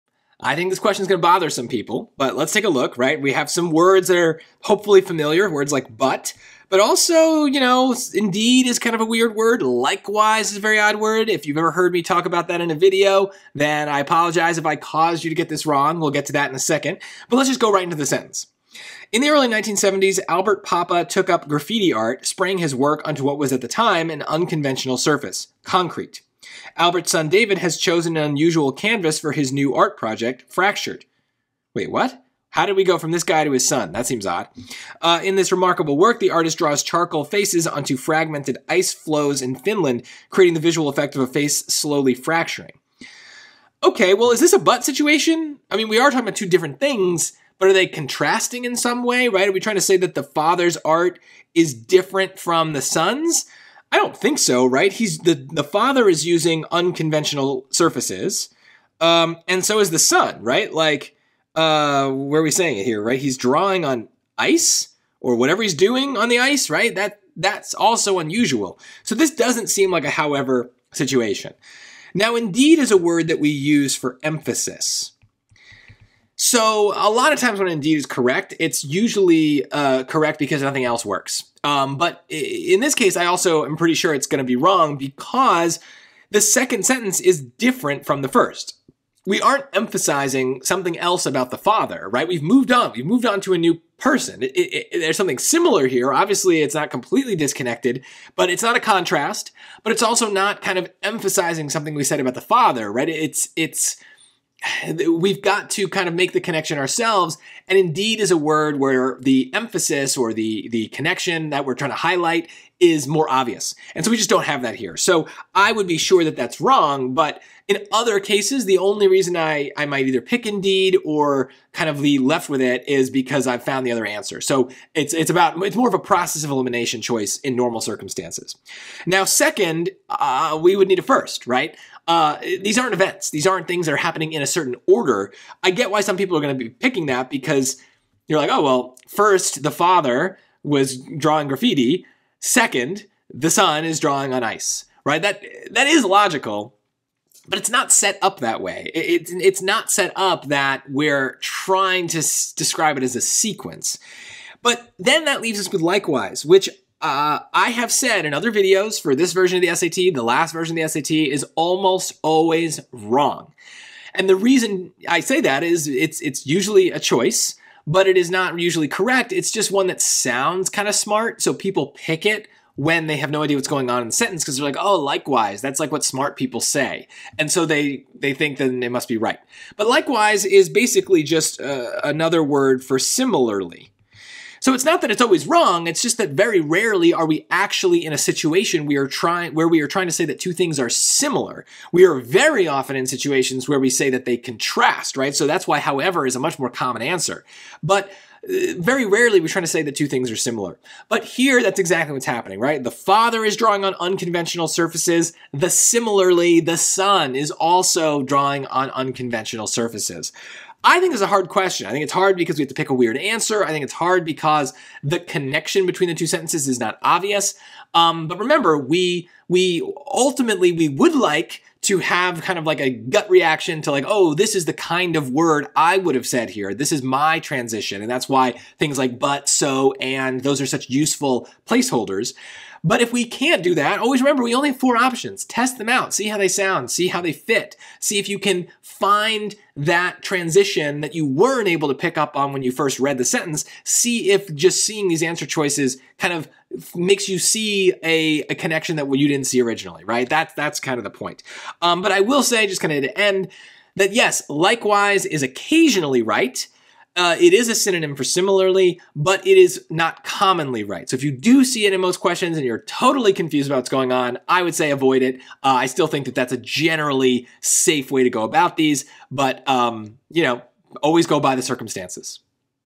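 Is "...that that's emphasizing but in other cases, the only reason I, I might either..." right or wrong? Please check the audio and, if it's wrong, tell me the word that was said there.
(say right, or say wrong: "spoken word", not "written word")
wrong: "wrong", not "emphasizing".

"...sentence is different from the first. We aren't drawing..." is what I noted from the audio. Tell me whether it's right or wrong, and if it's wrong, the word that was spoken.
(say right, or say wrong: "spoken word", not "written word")
wrong: "emphasizing", not "drawing".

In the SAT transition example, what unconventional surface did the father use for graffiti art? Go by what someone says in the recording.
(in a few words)
concrete.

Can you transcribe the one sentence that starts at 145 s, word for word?
That, that is logical but it's not set up that way.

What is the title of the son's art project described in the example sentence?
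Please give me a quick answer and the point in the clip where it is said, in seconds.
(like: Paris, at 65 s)
Fractured, at 30 s.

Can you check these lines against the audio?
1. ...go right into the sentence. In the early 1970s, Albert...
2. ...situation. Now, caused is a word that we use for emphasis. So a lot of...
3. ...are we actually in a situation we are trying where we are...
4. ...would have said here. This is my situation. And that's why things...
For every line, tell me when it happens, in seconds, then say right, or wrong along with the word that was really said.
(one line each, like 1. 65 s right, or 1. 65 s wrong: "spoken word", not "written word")
1. 17 s right
2. 70 s wrong: "indeed", not "caused"
3. 187 s right
4. 225 s wrong: "transition", not "situation".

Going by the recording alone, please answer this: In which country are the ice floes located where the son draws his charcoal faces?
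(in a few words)
Finland.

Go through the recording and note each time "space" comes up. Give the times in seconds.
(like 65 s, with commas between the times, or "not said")
not said.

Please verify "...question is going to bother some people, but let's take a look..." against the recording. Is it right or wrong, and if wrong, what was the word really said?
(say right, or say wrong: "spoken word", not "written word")
right.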